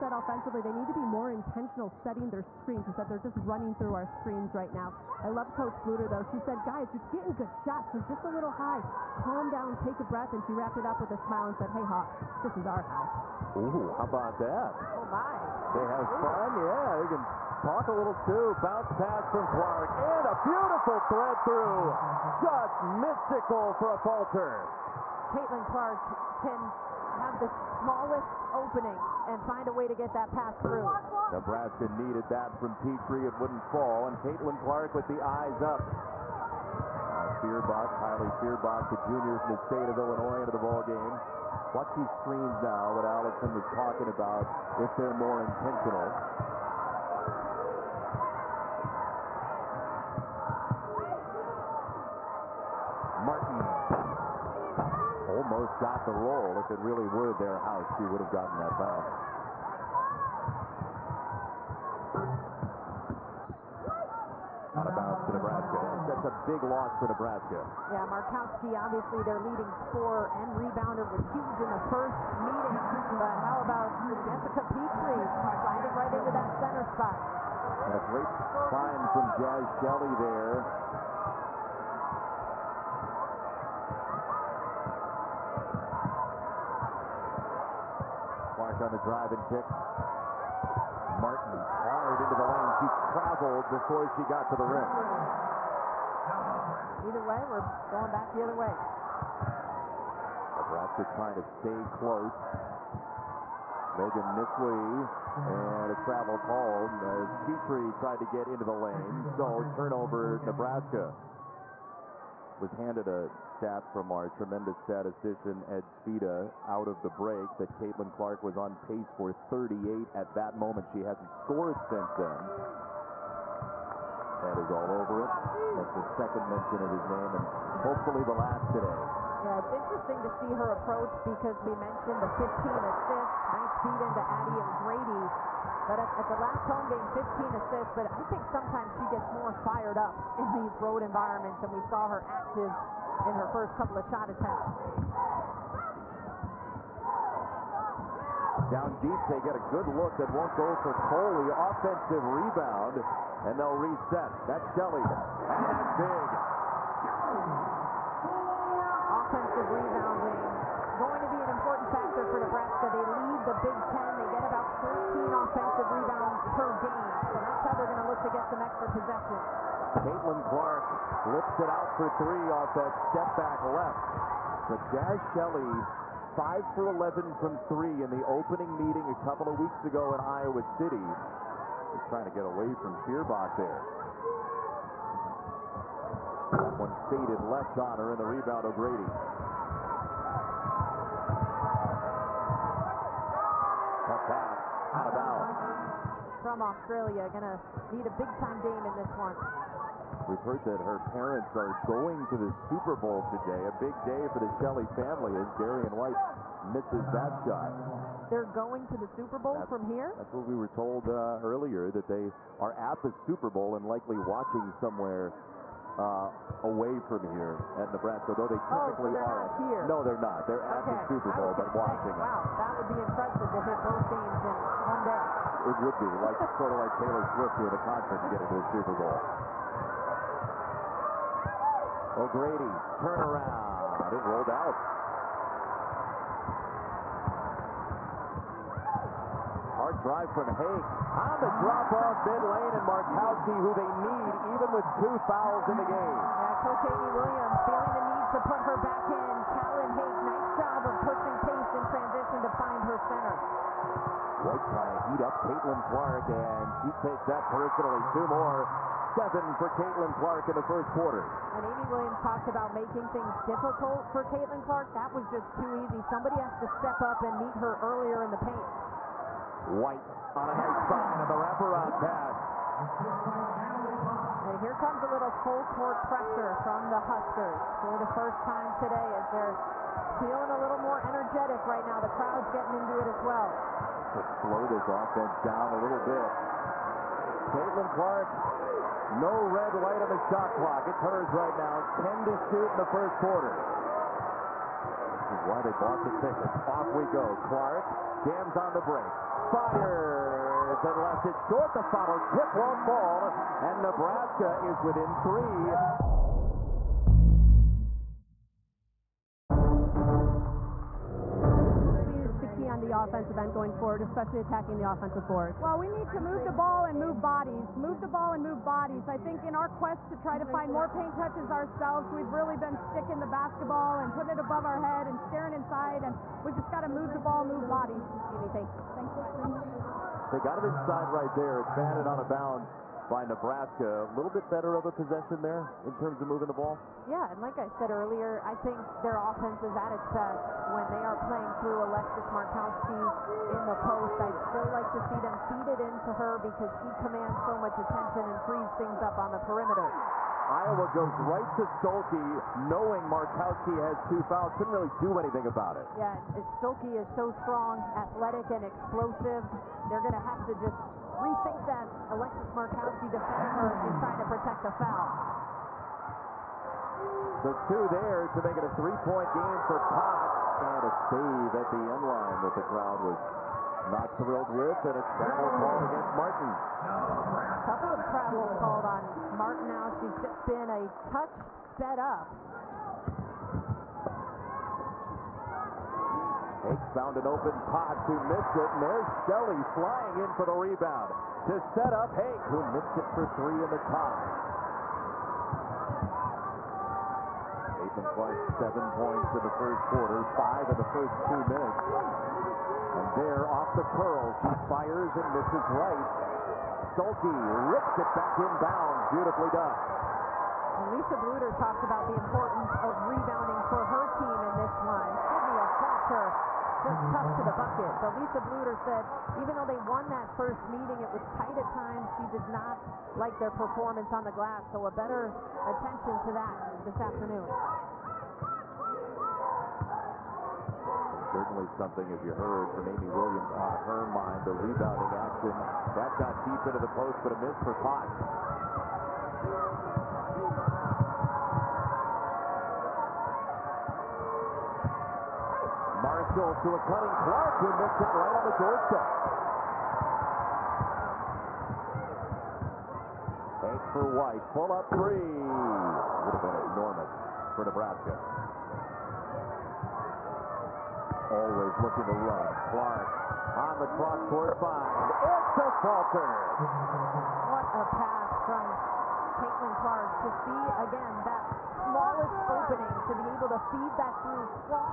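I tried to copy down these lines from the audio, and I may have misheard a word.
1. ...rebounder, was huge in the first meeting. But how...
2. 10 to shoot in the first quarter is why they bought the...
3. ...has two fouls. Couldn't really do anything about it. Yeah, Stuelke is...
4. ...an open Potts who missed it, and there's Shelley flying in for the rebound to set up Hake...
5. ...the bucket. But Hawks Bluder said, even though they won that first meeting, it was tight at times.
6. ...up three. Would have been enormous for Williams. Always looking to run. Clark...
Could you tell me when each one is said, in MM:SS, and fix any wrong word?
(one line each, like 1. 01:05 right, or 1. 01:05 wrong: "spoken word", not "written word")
1. 01:10 right
2. 04:52 right
3. 05:53 right
4. 06:27 right
5. 06:57 wrong: "Lisa", not "Hawks"
6. 07:34 wrong: "Nebraska", not "Williams".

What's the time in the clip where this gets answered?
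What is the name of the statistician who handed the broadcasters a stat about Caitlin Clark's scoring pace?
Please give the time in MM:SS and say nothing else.
01:55.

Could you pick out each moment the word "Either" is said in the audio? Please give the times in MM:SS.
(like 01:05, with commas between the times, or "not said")
01:37.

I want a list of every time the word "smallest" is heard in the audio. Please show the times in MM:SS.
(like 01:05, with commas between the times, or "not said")
00:27, 07:51.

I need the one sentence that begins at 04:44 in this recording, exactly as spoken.
Just to slow this offense down a little bit.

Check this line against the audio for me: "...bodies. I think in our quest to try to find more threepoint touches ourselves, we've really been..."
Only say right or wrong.
wrong.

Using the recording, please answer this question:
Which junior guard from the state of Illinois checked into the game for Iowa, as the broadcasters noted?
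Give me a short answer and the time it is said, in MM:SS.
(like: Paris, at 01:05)
Kylie Feuerbach, at 00:37.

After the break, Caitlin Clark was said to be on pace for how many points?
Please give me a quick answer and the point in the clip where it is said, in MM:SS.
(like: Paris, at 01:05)
38, at 01:59.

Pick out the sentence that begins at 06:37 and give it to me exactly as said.
Caitlin Clark, seven points in the first quarter, five in the first two minutes.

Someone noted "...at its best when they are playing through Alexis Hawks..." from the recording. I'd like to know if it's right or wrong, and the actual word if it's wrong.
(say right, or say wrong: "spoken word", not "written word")
wrong: "Markowski", not "Hawks".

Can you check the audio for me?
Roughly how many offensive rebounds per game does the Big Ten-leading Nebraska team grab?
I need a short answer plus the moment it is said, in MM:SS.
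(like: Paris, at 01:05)
13, at 02:45.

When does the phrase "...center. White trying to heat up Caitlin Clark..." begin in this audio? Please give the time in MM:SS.
04:12.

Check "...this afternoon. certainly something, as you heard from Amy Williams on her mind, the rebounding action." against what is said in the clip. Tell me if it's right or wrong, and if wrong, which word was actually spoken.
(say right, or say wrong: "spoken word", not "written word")
right.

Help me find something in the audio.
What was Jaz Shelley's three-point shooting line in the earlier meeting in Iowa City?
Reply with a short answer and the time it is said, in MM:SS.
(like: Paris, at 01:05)
5 for 11, at 02:56.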